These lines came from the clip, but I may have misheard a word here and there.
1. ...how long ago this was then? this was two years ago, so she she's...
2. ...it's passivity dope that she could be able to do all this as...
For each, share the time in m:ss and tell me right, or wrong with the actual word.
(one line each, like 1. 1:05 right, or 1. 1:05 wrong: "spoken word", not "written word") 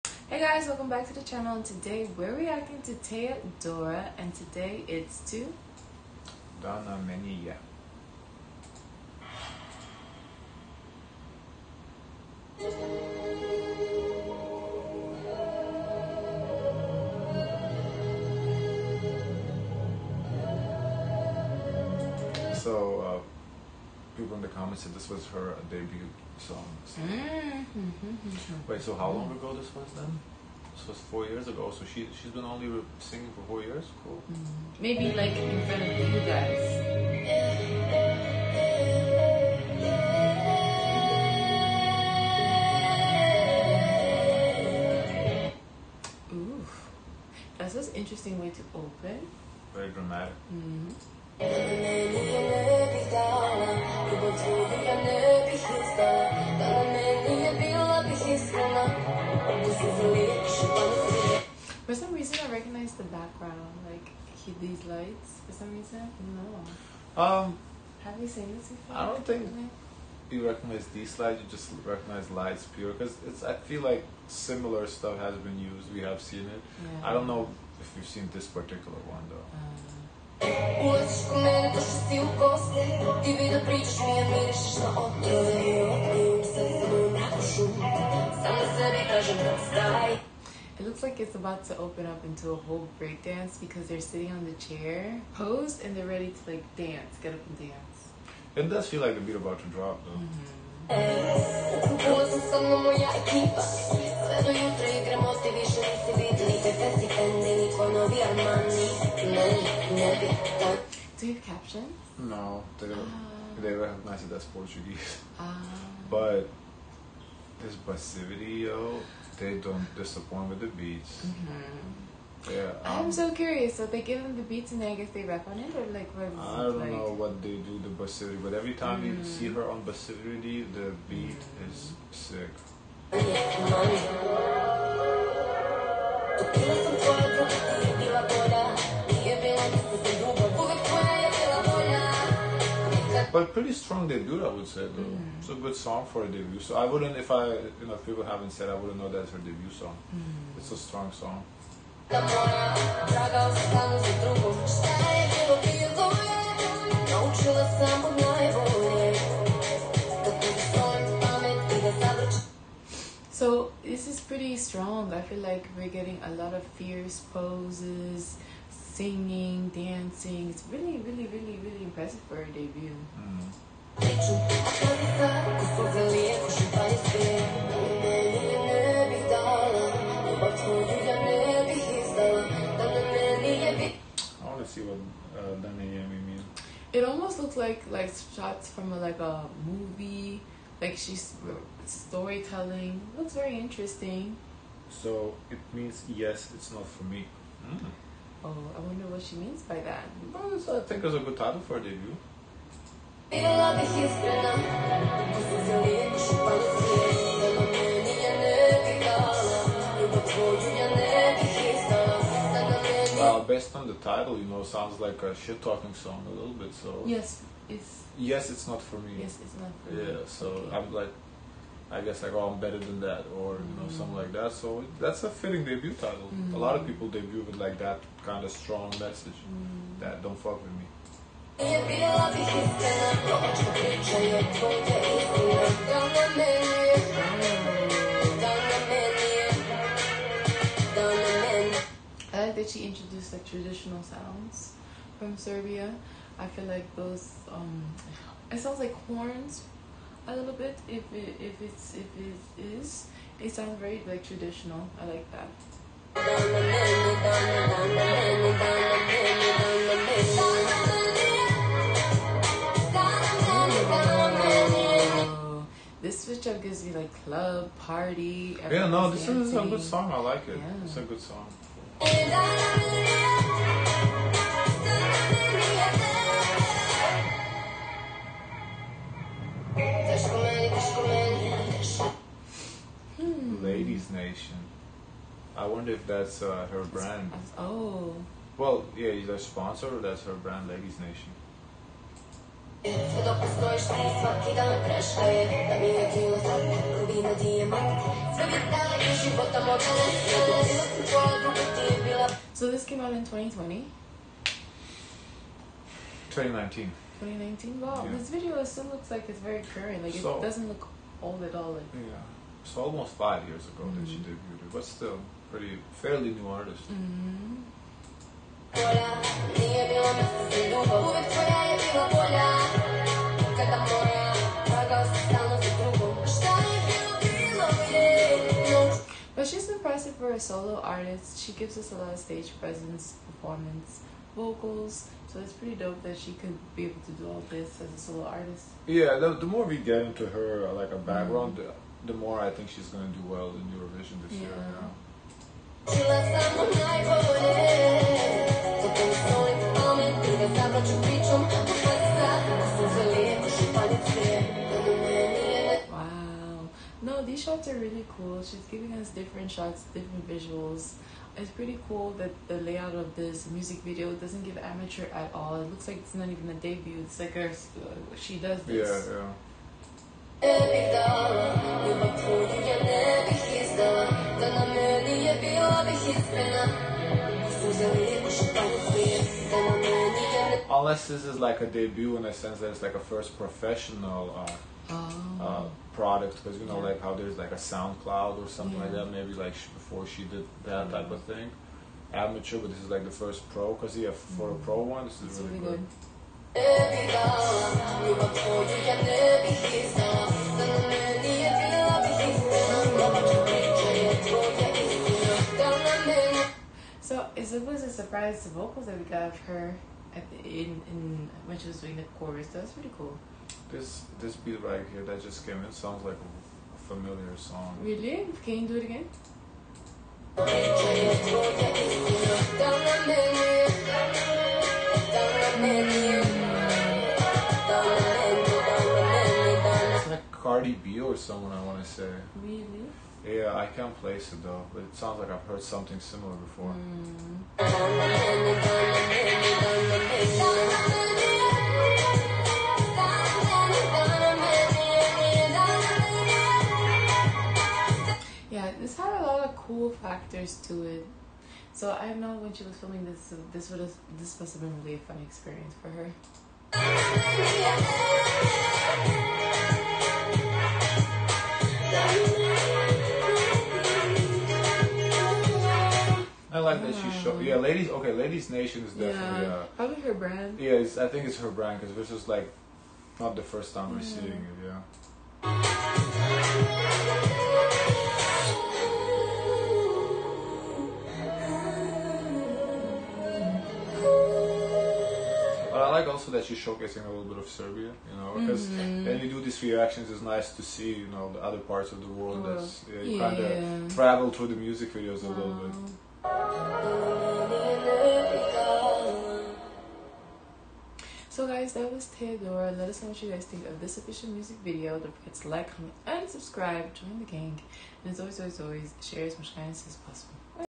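1. 0:28 wrong: "four", not "two"
2. 5:35 wrong: "pretty", not "passivity".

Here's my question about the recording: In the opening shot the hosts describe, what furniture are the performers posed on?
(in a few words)
chair.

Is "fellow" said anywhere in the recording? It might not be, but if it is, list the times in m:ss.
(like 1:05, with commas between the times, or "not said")
not said.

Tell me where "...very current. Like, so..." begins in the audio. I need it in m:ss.
5:09.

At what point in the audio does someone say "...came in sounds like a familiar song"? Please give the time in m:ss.
6:55.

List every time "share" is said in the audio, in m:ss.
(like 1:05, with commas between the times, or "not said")
8:29.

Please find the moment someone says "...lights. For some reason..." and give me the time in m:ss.
1:04.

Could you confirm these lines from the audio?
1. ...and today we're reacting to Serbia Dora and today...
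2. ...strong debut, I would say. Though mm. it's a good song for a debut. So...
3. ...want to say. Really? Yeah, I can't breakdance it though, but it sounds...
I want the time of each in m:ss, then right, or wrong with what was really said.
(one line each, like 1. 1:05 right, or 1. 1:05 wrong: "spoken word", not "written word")
1. 0:01 wrong: "Teya", not "Serbia"
2. 2:23 right
3. 7:11 wrong: "place", not "breakdance".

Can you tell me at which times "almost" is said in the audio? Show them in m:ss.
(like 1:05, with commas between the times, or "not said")
3:07, 5:12.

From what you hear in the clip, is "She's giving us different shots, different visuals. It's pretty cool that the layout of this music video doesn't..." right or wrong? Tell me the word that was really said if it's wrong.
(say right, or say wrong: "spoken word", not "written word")
right.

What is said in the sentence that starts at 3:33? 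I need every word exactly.
Well, based on the title, you know, sounds like a shit talking song a little bit.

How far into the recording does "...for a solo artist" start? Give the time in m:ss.
5:30.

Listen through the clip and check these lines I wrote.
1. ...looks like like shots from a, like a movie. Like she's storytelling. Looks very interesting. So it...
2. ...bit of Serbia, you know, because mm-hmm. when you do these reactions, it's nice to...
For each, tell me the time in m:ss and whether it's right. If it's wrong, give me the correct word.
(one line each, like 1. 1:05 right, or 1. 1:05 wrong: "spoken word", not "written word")
1. 3:07 right
2. 8:07 right.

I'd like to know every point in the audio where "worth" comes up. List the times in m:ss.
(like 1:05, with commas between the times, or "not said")
not said.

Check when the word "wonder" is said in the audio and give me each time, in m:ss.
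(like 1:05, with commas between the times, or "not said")
3:18, 4:45.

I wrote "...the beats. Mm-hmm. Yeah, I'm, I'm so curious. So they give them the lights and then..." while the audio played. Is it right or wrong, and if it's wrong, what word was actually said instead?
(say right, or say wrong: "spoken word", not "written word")
wrong: "beats", not "lights".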